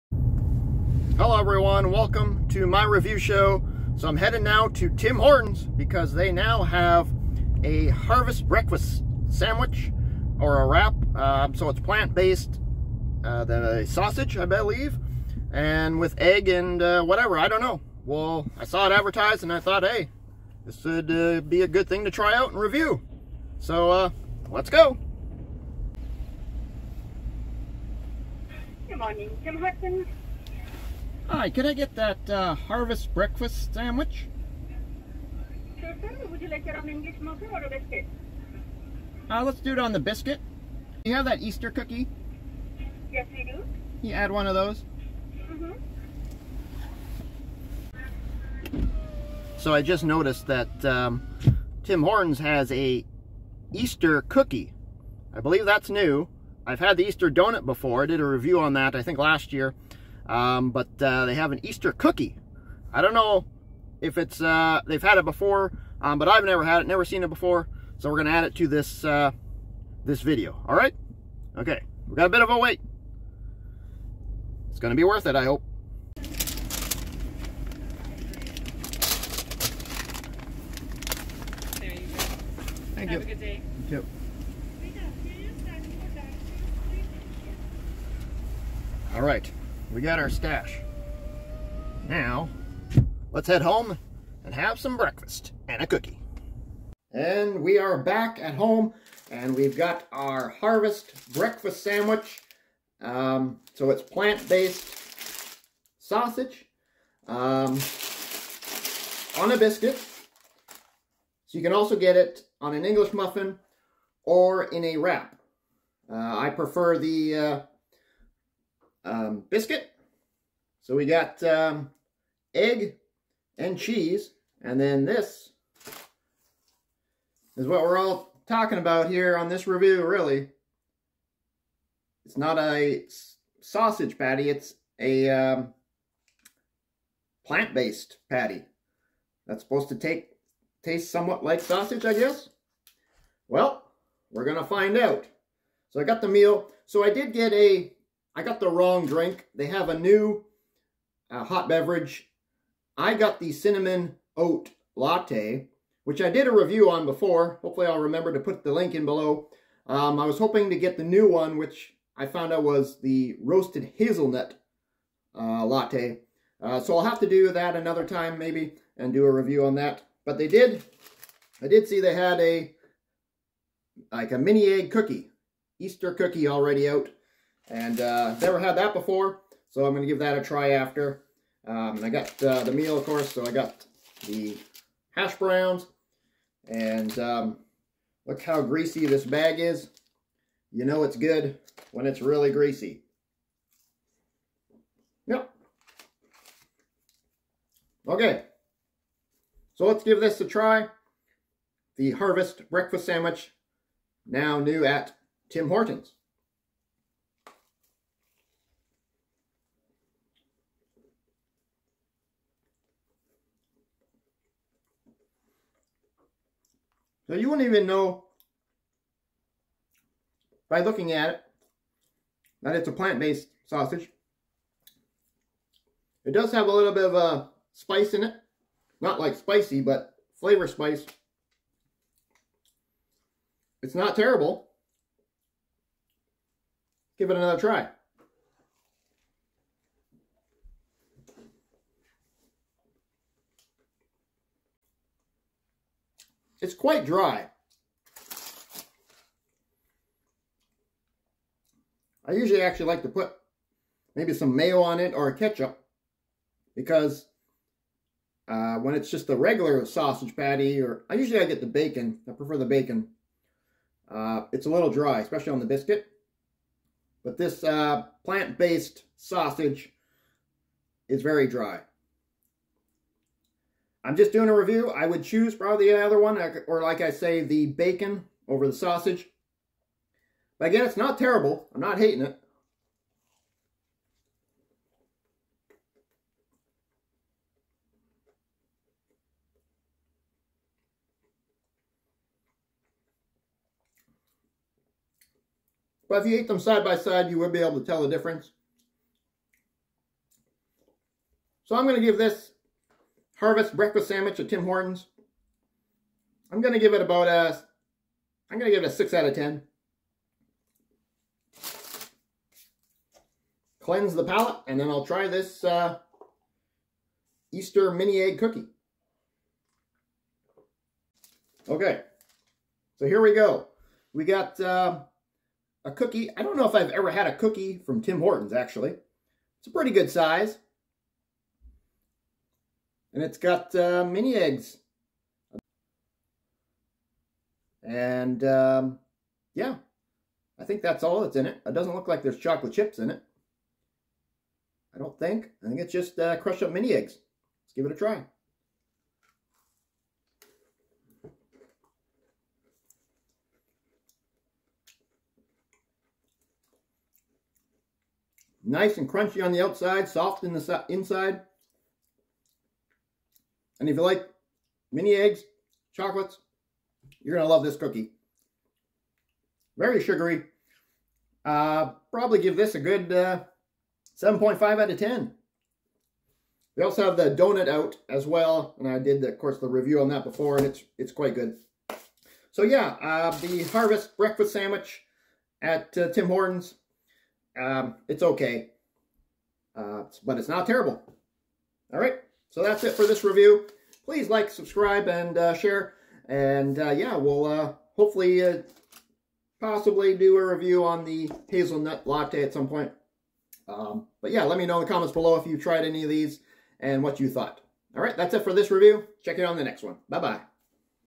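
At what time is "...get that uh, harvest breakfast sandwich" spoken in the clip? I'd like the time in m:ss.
0:31.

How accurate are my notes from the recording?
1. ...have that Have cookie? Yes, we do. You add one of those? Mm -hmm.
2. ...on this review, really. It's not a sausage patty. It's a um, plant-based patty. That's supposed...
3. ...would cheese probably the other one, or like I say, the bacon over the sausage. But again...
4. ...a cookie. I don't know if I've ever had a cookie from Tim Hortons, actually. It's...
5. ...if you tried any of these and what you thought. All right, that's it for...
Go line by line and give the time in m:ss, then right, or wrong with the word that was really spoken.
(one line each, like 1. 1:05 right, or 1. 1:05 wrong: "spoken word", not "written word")
1. 0:41 wrong: "Easter", not "Have"
2. 2:09 right
3. 4:35 wrong: "choose", not "cheese"
4. 5:25 right
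5. 6:45 right.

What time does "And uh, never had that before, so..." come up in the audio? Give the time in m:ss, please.
2:57.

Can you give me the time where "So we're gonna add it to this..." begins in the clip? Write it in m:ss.
1:07.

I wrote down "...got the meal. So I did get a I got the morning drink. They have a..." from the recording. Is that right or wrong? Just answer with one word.
wrong.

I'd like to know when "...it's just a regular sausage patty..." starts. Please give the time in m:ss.
4:18.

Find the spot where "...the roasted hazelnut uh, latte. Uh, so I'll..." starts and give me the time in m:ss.
2:43.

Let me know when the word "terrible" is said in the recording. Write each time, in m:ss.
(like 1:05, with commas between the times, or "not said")
3:54, 4:41, 6:30.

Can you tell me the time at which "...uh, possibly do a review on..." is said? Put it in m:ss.
6:38.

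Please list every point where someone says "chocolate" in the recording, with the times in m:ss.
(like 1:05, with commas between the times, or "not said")
5:42, 6:05.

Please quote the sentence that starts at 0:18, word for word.
Well, I saw it advertised and I thought, hey, this would uh, be a good thing to try out and review.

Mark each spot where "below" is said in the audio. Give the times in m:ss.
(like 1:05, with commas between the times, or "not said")
2:39, 6:45.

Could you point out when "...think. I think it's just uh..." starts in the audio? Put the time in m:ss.
5:45.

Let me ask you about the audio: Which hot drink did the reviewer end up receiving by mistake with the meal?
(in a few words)
Cinnamon oat latte.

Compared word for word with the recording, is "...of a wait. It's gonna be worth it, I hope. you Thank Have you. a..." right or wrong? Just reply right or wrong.
right.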